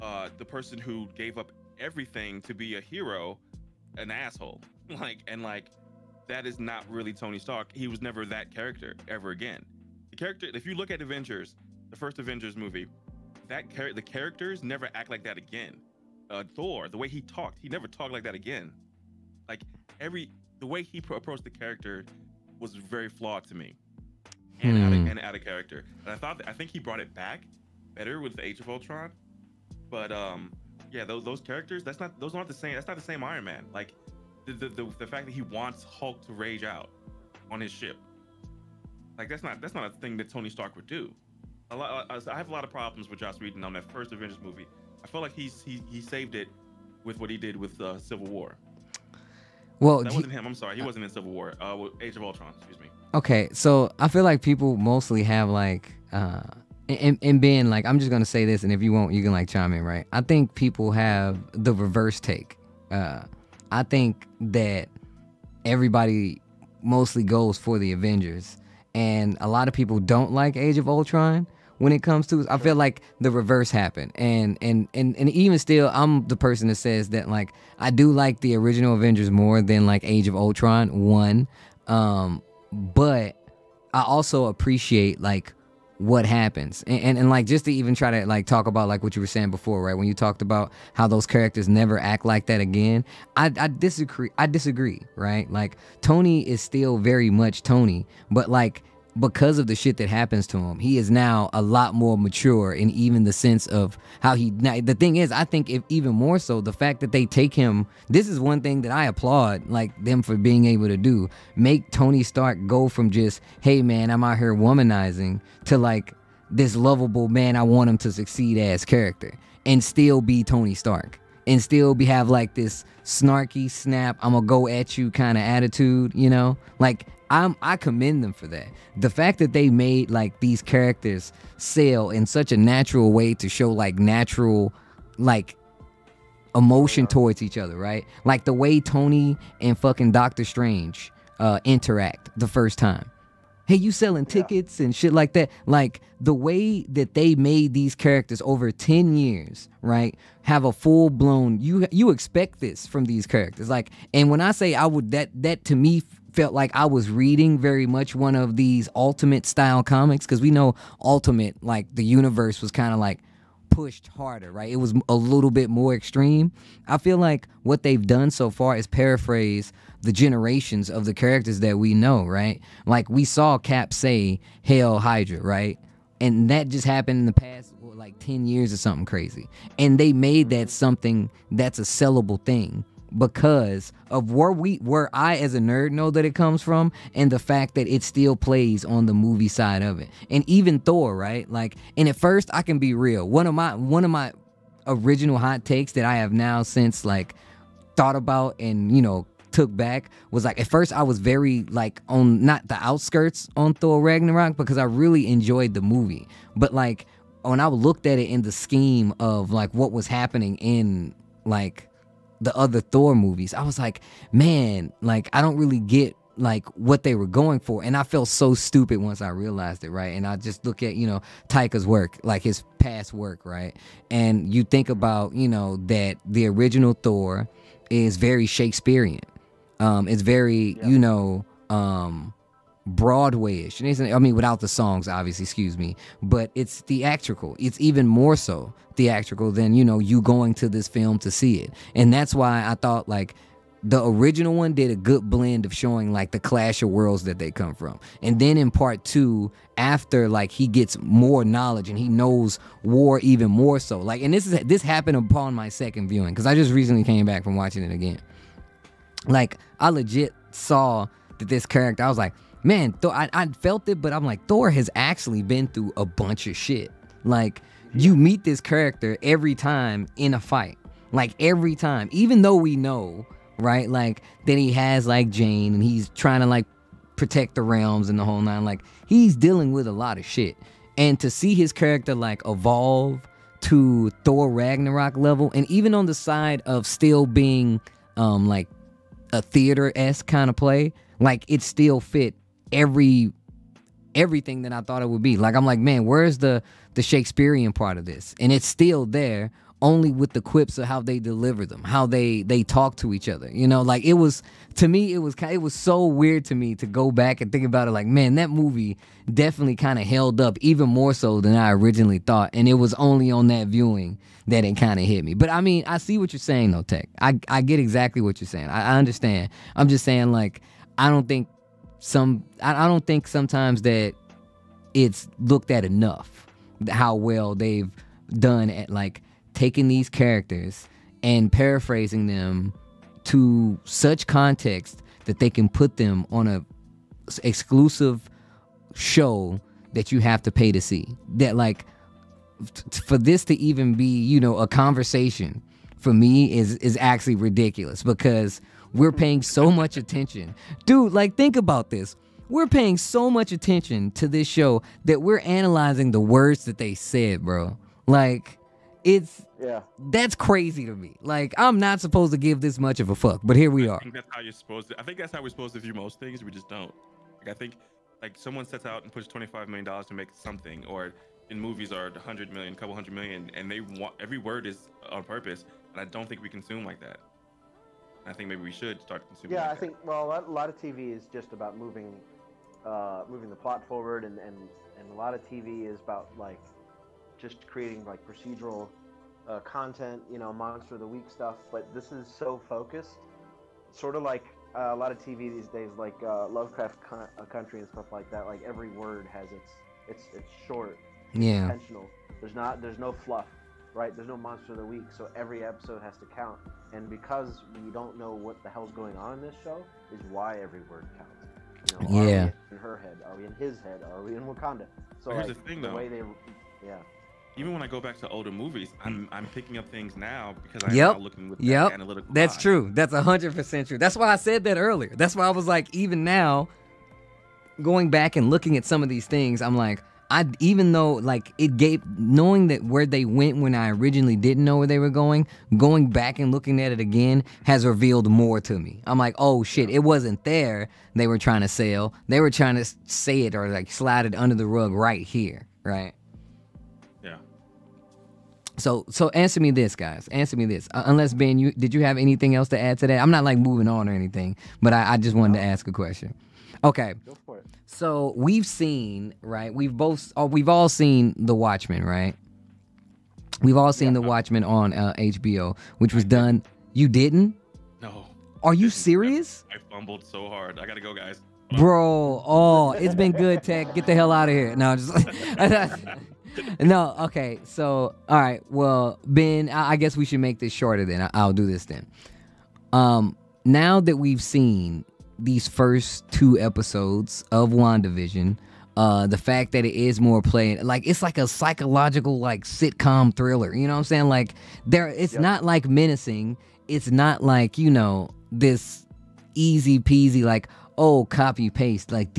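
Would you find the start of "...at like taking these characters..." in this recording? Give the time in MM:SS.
05:28.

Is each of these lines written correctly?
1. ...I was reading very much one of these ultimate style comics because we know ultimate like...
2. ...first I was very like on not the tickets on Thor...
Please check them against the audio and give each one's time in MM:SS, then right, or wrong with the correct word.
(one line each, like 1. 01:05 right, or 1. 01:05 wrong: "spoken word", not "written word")
1. 02:36 right
2. 03:20 wrong: "outskirts", not "tickets".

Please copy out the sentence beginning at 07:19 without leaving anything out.
I'm like, oh shit, it wasn't there.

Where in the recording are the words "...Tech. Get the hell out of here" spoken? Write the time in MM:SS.
07:53.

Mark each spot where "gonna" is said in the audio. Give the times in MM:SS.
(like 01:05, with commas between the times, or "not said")
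00:58, 02:04.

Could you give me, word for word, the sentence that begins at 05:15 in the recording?
But I mean, I see what you're saying, though, Tech.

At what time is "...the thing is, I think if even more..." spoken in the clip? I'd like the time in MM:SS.
01:44.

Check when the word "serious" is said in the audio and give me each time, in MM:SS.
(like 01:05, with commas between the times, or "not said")
07:48.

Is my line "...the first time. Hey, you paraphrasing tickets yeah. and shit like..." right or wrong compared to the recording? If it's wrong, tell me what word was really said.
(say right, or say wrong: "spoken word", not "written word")
wrong: "selling", not "paraphrasing".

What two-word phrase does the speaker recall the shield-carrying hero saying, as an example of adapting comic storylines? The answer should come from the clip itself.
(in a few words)
Hail Hydra.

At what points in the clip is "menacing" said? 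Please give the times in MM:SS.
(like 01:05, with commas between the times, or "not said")
08:15.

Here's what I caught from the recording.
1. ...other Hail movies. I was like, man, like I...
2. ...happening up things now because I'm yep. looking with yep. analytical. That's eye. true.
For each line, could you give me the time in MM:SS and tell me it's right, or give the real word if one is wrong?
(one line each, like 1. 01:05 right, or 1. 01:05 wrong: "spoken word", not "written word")
1. 03:32 wrong: "Thor", not "Hail"
2. 06:59 wrong: "picking", not "happening".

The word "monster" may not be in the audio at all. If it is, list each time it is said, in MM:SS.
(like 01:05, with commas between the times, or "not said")
06:30, 06:44.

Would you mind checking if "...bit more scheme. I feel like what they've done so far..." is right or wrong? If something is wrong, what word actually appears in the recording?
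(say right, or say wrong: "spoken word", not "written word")
wrong: "extreme", not "scheme".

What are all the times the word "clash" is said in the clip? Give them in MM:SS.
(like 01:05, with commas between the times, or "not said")
04:06.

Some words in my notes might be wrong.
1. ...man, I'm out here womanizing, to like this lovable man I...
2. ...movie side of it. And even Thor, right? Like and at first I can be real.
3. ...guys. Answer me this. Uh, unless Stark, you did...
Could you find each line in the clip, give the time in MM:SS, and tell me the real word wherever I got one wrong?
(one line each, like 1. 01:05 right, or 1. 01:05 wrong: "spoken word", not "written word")
1. 01:53 right
2. 03:09 right
3. 07:29 wrong: "Ben", not "Stark".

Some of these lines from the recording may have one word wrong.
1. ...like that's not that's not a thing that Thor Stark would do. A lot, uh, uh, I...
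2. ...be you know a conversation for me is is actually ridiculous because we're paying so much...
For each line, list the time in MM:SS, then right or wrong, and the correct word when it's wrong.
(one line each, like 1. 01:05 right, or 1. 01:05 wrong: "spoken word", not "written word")
1. 00:39 wrong: "Tony", not "Thor"
2. 05:43 right.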